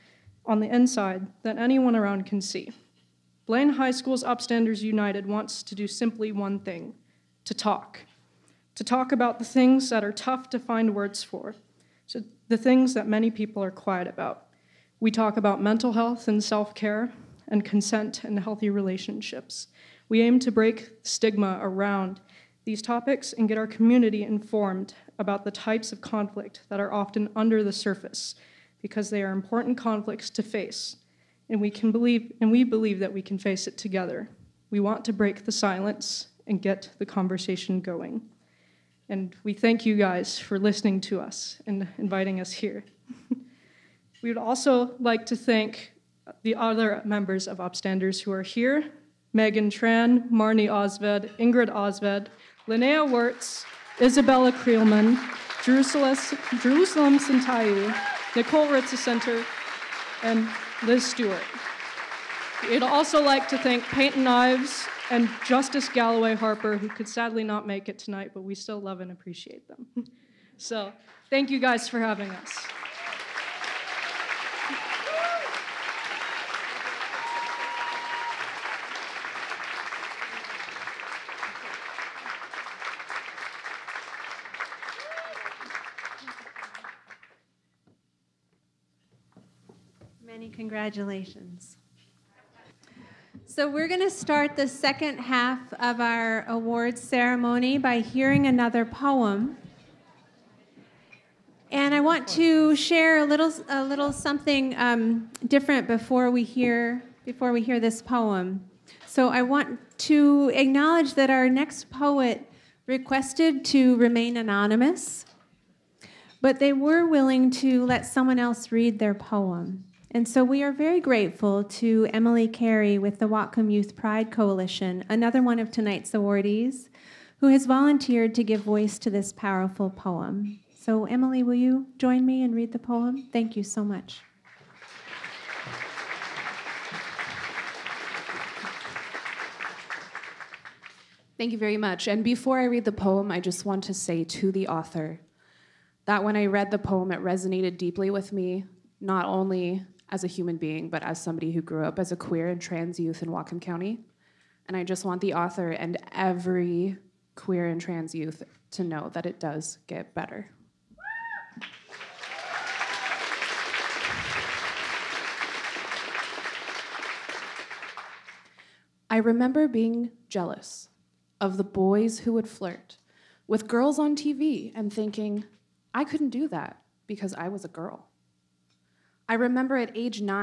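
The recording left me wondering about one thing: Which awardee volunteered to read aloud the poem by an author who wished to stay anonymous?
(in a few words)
Emily Carey.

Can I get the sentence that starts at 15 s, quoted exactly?
We talk about mental health and self care, and consent and healthy relationships.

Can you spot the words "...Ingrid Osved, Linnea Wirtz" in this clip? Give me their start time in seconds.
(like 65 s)
51 s.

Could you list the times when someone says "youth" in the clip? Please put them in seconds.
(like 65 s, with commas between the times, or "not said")
123 s, 152 s, 158 s.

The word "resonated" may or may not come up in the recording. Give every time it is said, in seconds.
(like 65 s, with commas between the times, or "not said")
147 s.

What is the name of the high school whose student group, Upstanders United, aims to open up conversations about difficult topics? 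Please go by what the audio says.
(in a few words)
Blaine High School.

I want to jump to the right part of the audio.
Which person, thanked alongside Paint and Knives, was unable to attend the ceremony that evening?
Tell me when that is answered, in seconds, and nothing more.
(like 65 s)
65 s.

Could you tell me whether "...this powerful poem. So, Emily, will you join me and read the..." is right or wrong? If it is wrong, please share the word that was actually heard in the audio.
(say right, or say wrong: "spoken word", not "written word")
right.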